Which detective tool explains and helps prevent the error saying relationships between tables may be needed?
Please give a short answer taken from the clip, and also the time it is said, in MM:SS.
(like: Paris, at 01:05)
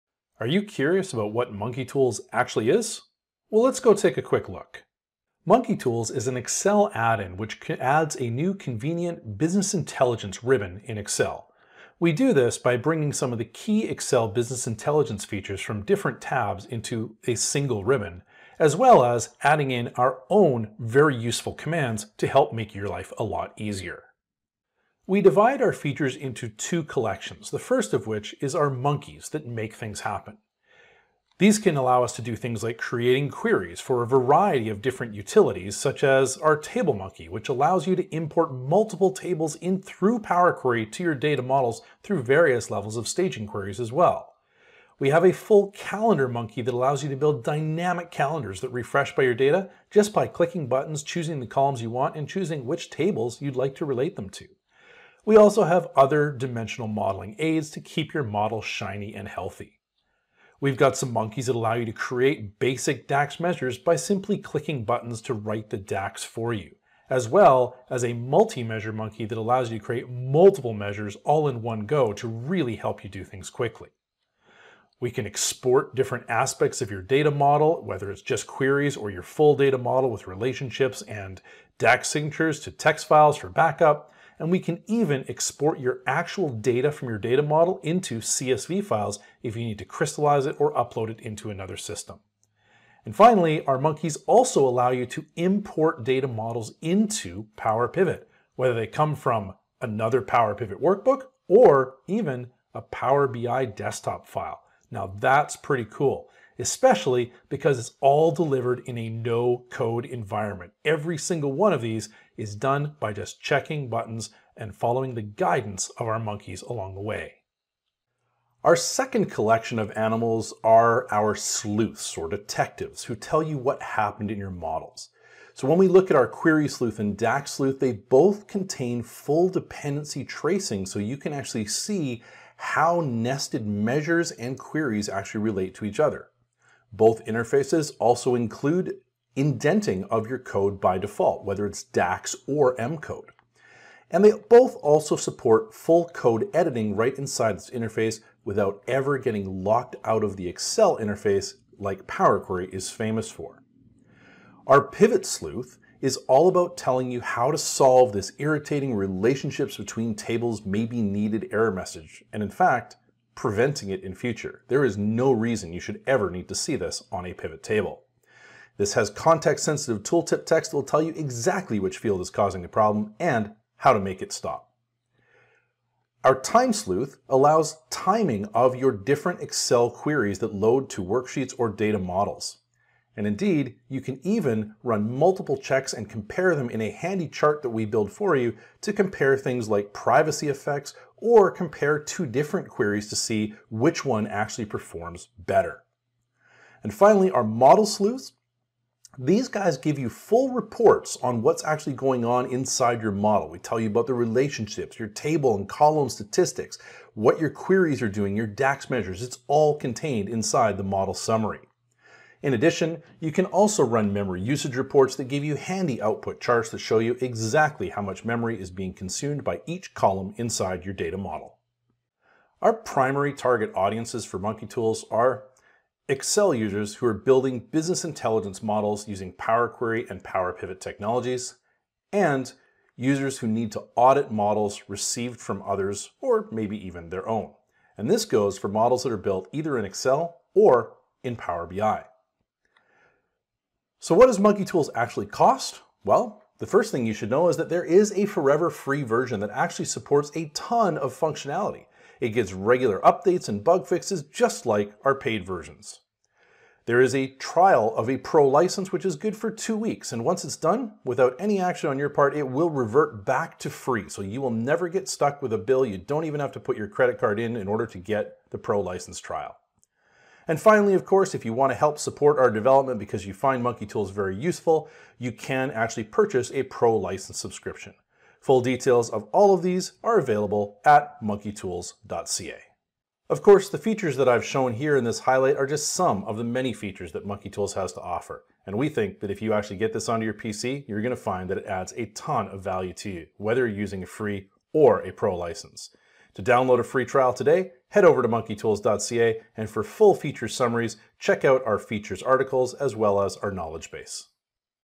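Pivot Sleuth, at 02:34.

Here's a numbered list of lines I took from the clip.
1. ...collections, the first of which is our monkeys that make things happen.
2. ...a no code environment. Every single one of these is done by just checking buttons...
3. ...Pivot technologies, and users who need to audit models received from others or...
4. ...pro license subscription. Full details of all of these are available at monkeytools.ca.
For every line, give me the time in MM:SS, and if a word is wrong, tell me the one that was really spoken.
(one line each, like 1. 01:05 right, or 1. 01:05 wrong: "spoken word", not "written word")
1. 00:26 right
2. 01:48 right
3. 03:50 right
4. 04:36 right.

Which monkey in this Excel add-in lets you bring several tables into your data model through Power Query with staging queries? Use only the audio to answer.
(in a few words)
table monkey.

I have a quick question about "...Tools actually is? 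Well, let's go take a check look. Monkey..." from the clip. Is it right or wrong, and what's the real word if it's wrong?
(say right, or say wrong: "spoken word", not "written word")
wrong: "quick", not "check".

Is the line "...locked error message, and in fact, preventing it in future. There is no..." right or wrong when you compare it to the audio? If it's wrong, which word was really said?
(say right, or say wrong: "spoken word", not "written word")
wrong: "needed", not "locked".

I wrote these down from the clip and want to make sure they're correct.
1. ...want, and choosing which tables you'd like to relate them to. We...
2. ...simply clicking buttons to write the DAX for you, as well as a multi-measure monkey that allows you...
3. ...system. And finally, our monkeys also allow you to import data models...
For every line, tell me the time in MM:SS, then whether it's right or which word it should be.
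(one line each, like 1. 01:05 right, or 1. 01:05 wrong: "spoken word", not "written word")
1. 00:51 right
2. 01:03 right
3. 01:31 right.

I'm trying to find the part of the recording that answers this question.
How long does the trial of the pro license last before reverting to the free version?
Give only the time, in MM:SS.
04:19.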